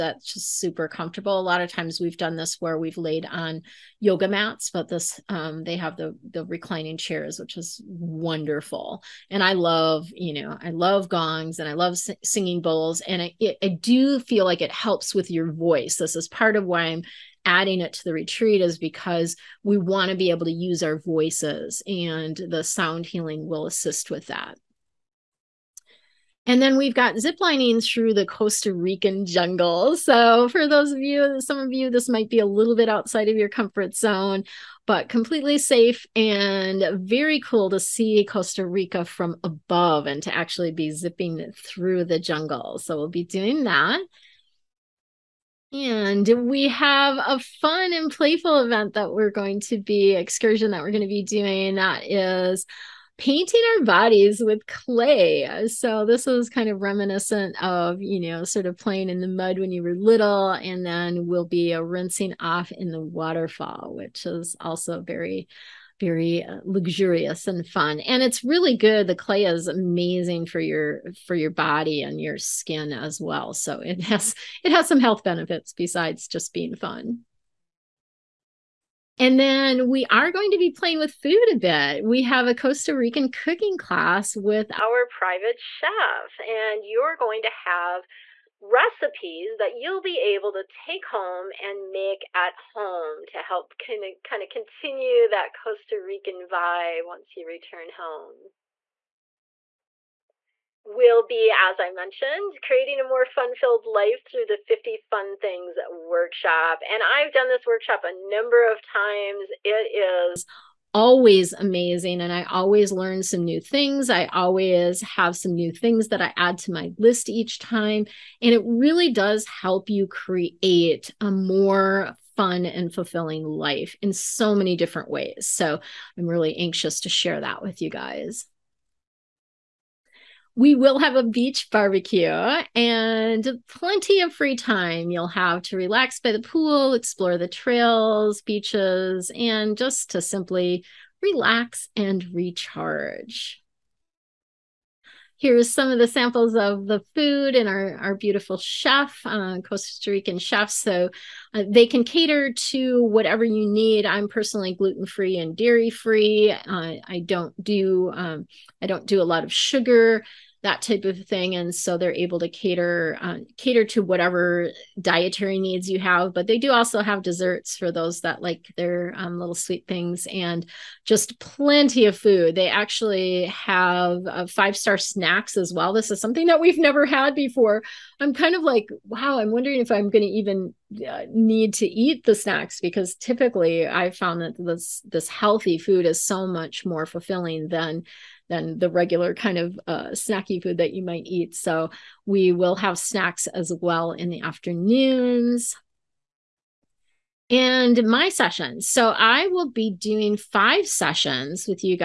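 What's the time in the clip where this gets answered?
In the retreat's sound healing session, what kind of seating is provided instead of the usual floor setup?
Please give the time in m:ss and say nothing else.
0:06.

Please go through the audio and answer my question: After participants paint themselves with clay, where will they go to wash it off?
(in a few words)
the waterfall.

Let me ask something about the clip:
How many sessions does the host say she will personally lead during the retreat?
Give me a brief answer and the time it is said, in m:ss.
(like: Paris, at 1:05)
5, at 3:20.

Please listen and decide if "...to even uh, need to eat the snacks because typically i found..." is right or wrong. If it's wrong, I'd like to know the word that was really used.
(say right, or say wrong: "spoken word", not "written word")
right.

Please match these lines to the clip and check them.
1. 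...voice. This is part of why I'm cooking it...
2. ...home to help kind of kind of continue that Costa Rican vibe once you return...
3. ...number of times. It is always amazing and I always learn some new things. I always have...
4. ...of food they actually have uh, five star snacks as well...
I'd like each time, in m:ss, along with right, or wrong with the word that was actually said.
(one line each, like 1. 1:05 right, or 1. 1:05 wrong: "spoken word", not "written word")
1. 0:15 wrong: "adding", not "cooking"
2. 1:32 right
3. 1:48 right
4. 2:52 right.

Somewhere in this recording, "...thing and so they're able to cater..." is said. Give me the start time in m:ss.
2:41.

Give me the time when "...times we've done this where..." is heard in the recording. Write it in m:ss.
0:01.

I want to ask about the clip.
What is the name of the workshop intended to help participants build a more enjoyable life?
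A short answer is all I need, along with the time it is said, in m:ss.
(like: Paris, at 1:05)
50 Fun Things, at 1:44.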